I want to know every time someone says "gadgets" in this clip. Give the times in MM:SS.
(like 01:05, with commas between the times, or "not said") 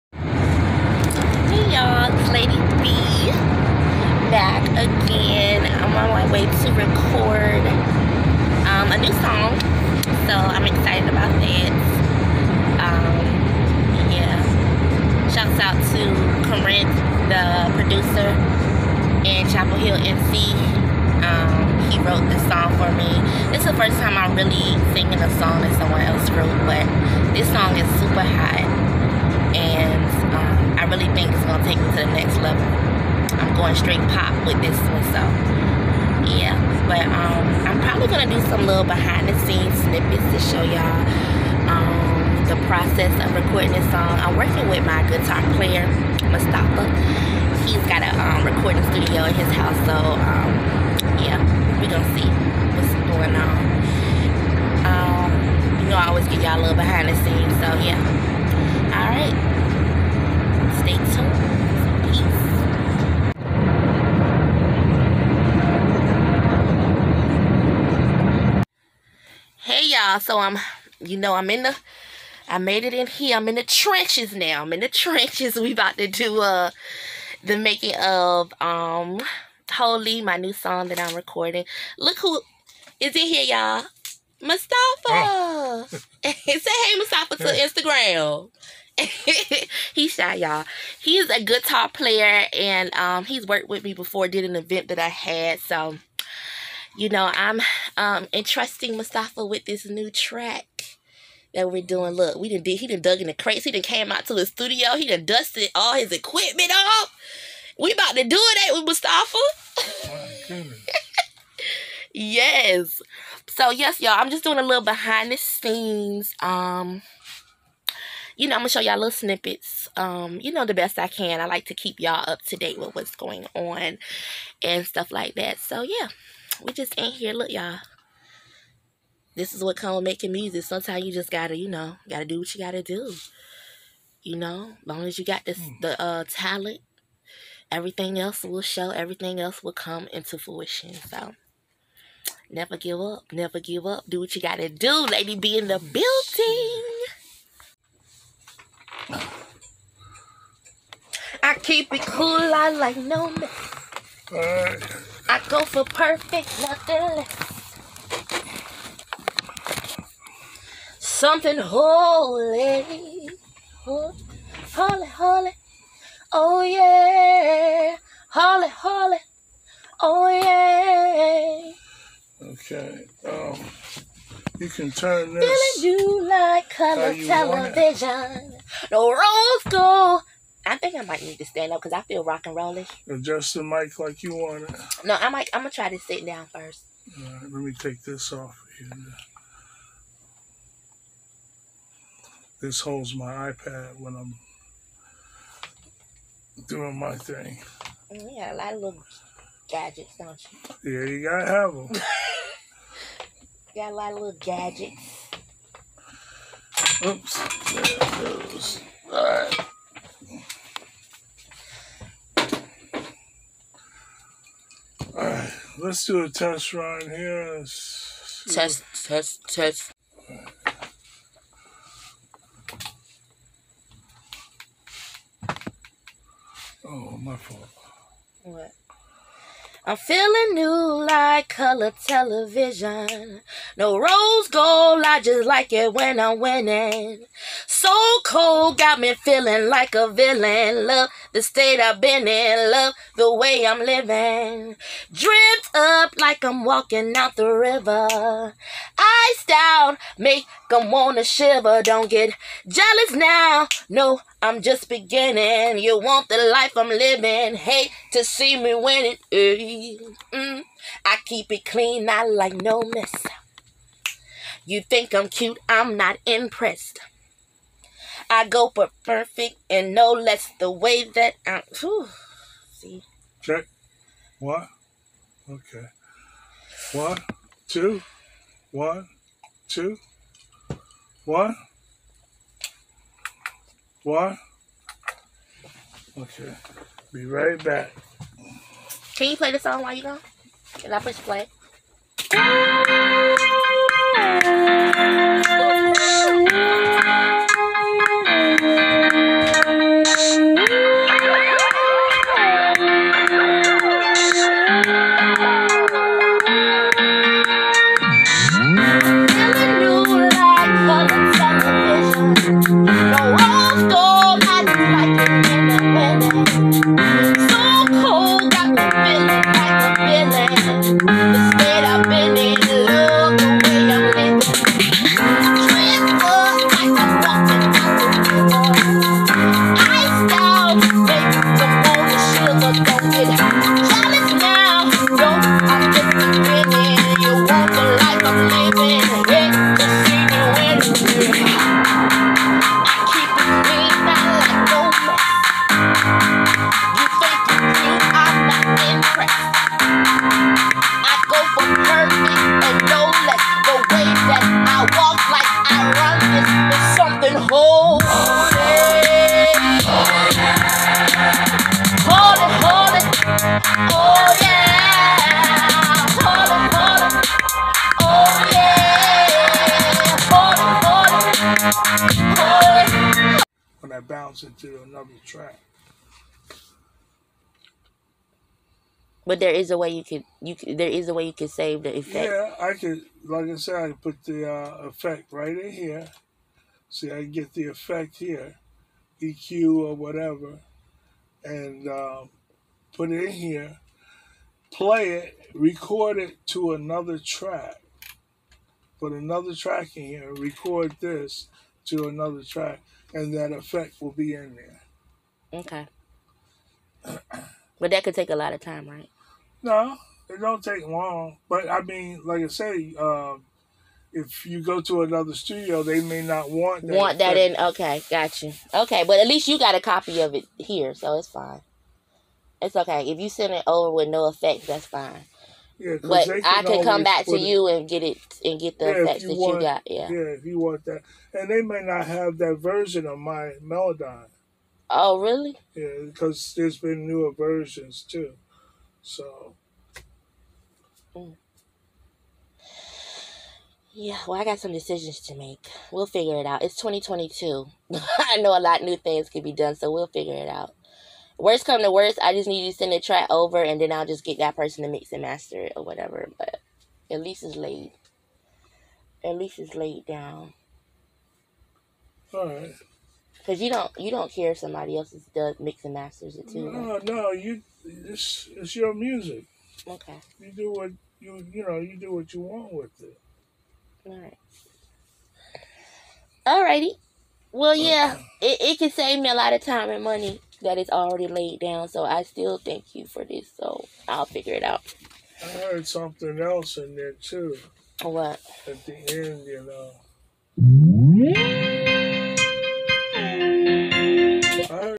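03:19, 03:24.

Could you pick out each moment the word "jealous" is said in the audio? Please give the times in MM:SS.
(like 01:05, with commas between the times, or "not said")
04:12.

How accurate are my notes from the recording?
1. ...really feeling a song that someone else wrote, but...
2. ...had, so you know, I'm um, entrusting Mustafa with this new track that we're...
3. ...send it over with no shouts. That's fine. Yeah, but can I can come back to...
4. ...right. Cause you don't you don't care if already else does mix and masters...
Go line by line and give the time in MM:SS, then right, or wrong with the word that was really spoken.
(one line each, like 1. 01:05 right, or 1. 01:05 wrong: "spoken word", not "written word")
1. 00:24 wrong: "singing", not "feeling"
2. 01:35 right
3. 07:03 wrong: "effects", not "shouts"
4. 07:42 wrong: "somebody", not "already".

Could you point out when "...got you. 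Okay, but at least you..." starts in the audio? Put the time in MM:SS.
06:58.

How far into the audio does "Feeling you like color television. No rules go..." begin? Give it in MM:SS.
02:55.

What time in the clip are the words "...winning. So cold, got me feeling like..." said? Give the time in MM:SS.
03:56.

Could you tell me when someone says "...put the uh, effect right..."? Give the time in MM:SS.
06:24.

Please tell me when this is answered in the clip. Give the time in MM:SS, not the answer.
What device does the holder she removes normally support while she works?
03:13.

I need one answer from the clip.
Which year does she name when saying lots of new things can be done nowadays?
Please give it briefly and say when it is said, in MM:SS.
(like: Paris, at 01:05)
2022, at 07:26.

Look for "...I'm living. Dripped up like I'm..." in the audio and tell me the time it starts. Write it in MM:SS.
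04:03.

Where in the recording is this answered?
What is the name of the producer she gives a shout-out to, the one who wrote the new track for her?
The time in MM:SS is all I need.
00:16.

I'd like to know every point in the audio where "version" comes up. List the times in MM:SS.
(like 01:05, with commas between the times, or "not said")
07:12, 07:17.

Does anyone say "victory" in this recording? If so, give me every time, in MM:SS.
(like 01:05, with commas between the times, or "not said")
not said.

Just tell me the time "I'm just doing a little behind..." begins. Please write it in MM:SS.
01:54.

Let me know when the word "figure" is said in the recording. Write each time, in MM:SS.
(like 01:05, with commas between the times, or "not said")
07:26, 07:30, 08:04.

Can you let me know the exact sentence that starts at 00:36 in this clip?
But um, I'm probably gonna do some little behind the scenes snippets to show y'all um, the process of recording this song.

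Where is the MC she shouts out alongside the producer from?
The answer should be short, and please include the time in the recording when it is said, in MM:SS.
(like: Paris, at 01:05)
Chapel Hill, at 00:19.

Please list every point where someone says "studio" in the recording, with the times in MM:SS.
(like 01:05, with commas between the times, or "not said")
01:44, 06:55.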